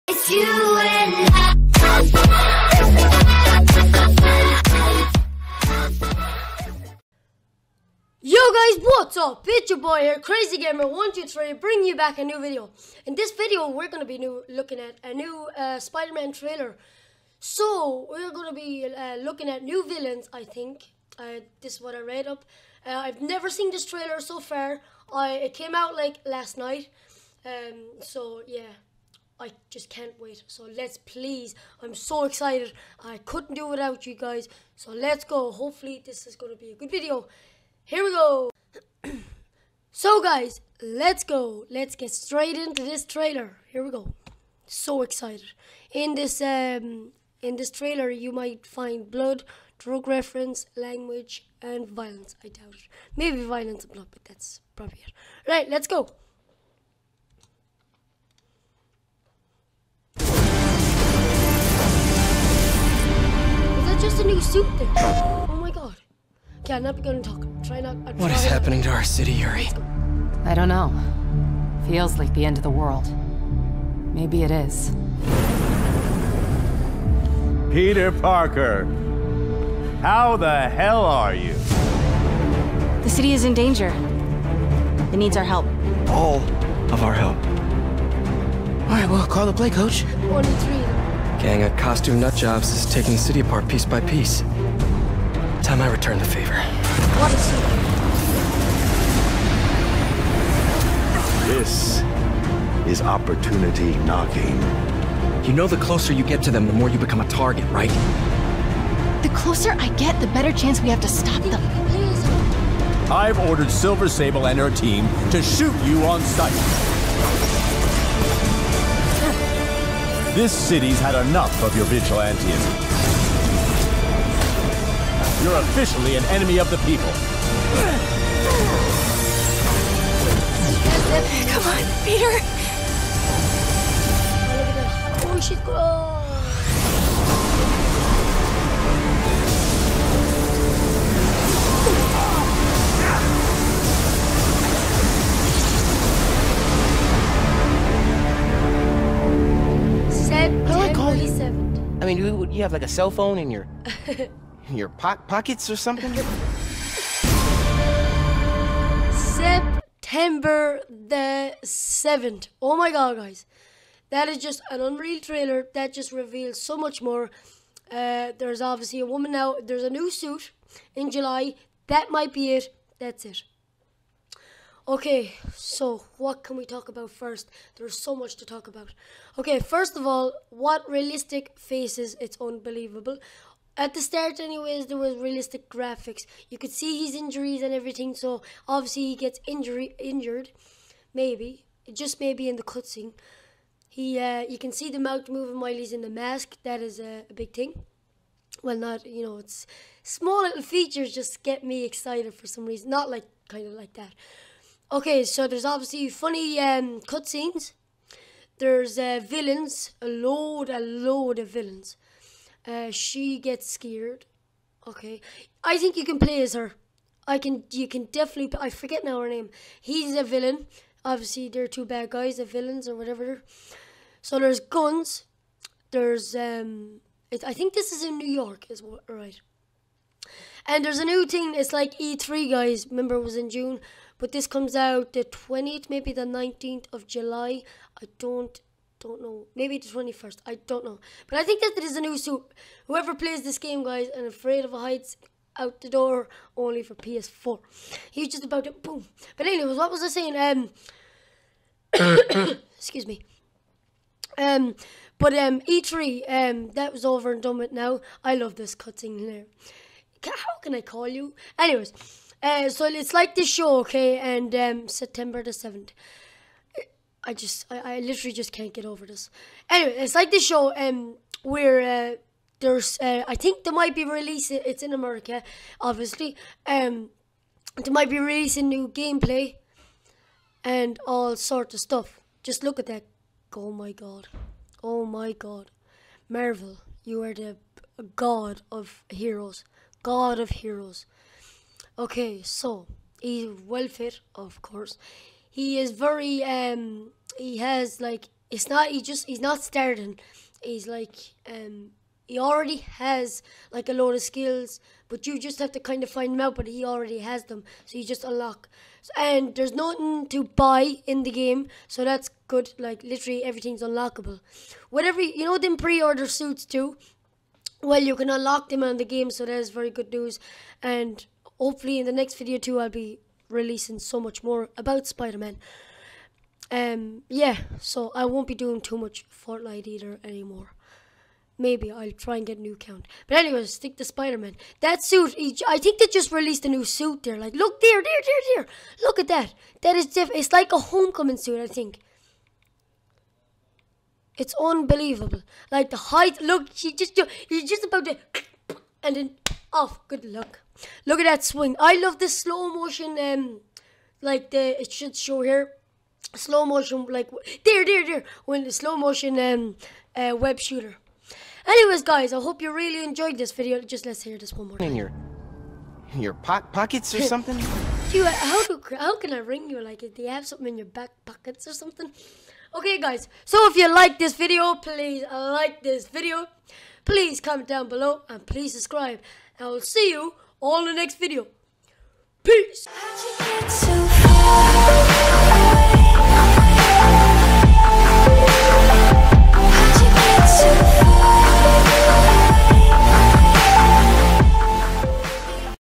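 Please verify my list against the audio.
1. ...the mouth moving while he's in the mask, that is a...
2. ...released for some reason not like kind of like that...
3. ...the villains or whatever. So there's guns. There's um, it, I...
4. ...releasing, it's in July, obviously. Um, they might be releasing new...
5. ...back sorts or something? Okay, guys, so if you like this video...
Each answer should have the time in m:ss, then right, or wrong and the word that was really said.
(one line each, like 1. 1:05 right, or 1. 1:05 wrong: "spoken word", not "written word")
1. 3:14 right
2. 3:21 wrong: "excited", not "released"
3. 3:42 right
4. 4:34 wrong: "America", not "July"
5. 6:10 wrong: "pockets", not "sorts".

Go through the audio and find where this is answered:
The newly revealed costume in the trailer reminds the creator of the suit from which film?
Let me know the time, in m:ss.
5:40.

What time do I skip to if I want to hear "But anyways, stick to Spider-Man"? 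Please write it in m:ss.
5:33.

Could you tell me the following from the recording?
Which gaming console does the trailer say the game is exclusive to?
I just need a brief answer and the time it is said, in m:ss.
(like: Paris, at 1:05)
PS4, at 4:06.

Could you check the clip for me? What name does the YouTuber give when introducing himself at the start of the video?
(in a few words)
Crazy Gamer 123.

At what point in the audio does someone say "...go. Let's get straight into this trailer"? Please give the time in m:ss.
0:41.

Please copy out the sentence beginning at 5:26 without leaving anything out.
Um, yeah, so I won't be doing too much Fortnite either anymore.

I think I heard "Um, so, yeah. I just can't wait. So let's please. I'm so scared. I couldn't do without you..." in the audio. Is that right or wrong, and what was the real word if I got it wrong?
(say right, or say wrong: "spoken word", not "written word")
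wrong: "excited", not "scared".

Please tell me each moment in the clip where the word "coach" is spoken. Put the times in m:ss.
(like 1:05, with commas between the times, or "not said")
1:29.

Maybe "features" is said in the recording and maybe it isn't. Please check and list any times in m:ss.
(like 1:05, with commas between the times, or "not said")
3:20.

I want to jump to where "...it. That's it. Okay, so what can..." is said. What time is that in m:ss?
2:52.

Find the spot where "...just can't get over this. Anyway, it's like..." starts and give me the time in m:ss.
4:28.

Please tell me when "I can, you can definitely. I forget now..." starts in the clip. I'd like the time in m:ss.
3:37.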